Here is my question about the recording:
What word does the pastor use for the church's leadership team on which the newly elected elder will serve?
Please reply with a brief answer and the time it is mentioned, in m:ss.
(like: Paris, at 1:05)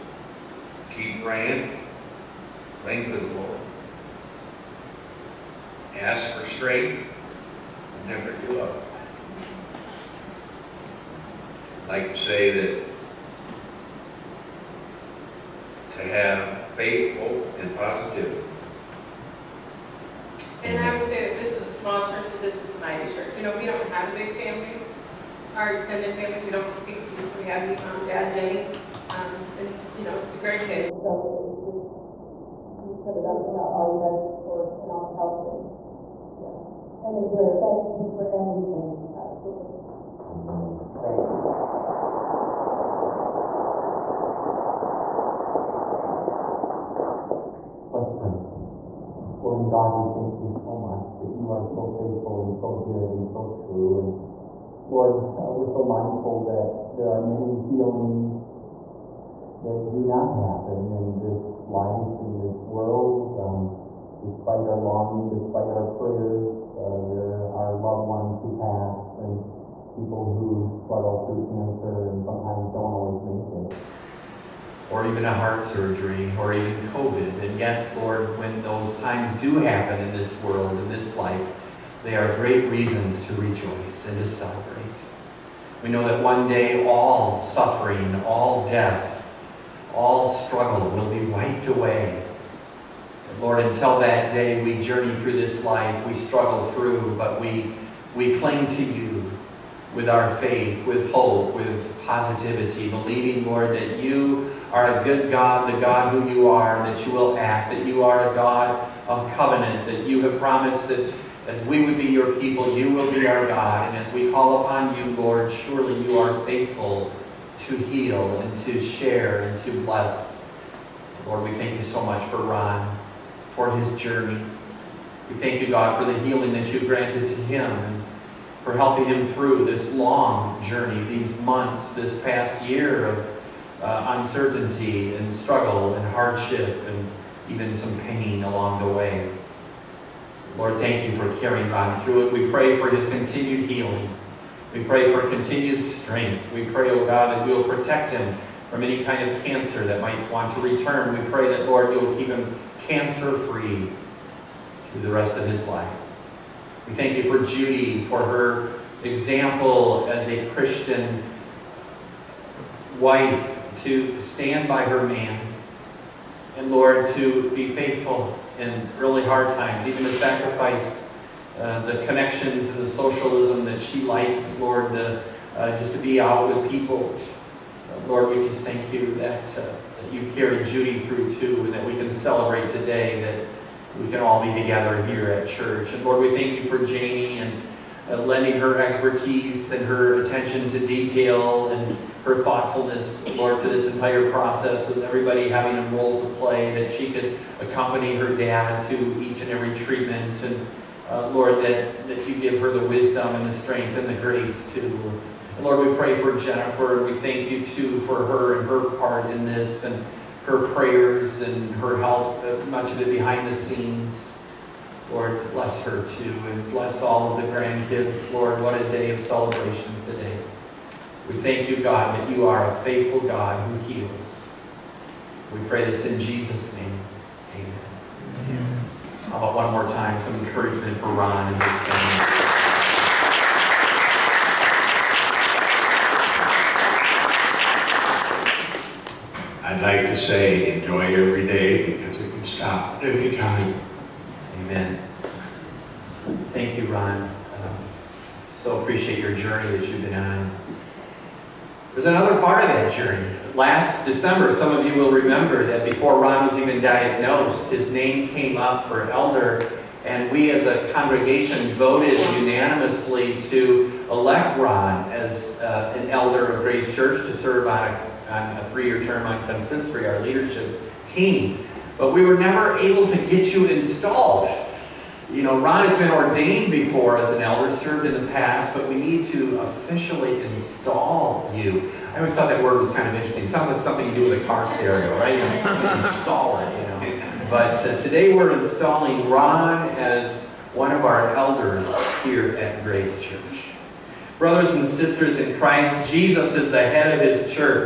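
consistory, at 4:29.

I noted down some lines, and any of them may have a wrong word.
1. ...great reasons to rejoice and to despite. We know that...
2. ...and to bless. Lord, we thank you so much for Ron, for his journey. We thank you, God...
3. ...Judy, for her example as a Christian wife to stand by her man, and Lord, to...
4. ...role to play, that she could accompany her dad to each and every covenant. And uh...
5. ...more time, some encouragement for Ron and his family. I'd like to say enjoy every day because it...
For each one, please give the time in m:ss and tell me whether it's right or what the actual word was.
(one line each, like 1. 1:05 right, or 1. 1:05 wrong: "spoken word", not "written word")
1. 1:22 wrong: "celebrate", not "despite"
2. 1:59 right
3. 2:37 right
4. 3:15 wrong: "treatment", not "covenant"
5. 3:49 right.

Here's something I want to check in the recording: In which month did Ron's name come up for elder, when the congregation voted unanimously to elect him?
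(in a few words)
December.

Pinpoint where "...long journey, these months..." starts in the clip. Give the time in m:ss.
2:09.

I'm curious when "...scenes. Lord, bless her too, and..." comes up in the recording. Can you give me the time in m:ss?
3:33.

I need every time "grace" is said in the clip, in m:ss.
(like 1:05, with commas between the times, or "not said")
3:24, 4:26, 4:52.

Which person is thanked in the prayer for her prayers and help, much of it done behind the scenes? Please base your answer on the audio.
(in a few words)
Jennifer.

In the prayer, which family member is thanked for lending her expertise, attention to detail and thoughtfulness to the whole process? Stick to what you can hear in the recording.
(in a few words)
Jamie.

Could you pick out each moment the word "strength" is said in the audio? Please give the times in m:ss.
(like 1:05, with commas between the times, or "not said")
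0:06, 2:25, 3:23.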